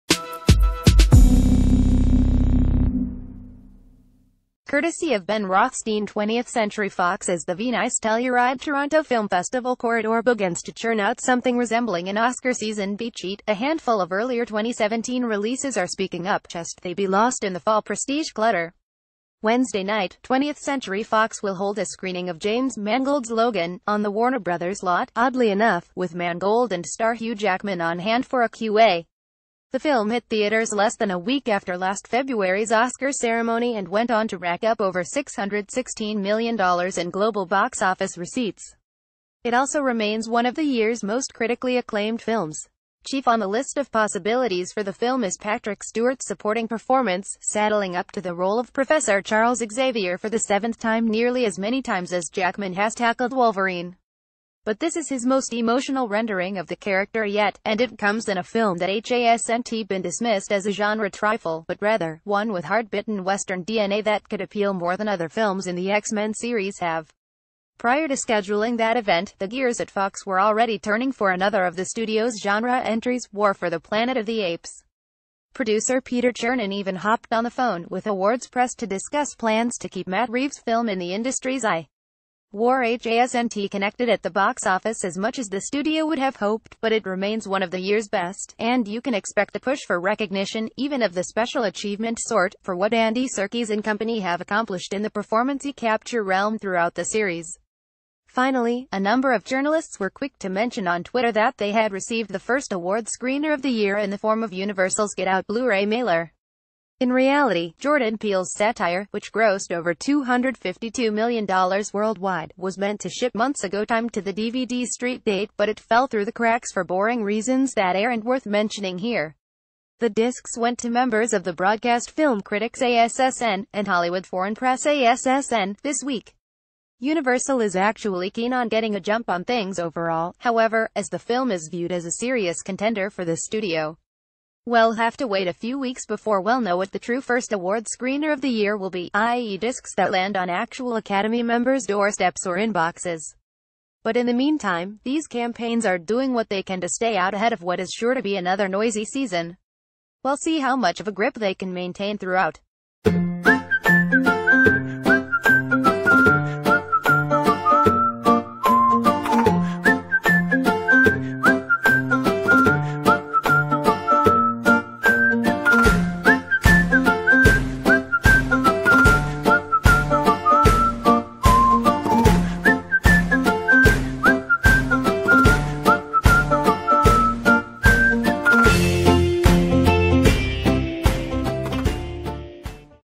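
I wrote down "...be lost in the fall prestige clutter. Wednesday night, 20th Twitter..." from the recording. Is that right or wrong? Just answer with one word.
wrong.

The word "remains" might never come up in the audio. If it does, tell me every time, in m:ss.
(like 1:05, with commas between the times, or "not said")
0:39, 1:27.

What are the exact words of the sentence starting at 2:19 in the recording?
discs that land on actual Academy members' doorsteps or inboxes.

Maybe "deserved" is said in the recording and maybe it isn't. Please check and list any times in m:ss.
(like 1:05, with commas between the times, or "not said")
not said.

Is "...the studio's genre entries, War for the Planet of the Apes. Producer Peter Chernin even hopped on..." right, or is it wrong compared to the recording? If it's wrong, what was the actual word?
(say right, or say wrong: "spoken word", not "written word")
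right.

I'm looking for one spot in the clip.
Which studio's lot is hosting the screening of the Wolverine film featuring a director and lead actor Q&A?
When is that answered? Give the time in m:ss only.
0:24.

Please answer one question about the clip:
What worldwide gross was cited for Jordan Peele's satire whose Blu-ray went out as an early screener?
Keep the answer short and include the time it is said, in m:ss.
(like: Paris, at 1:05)
over $252 million, at 1:49.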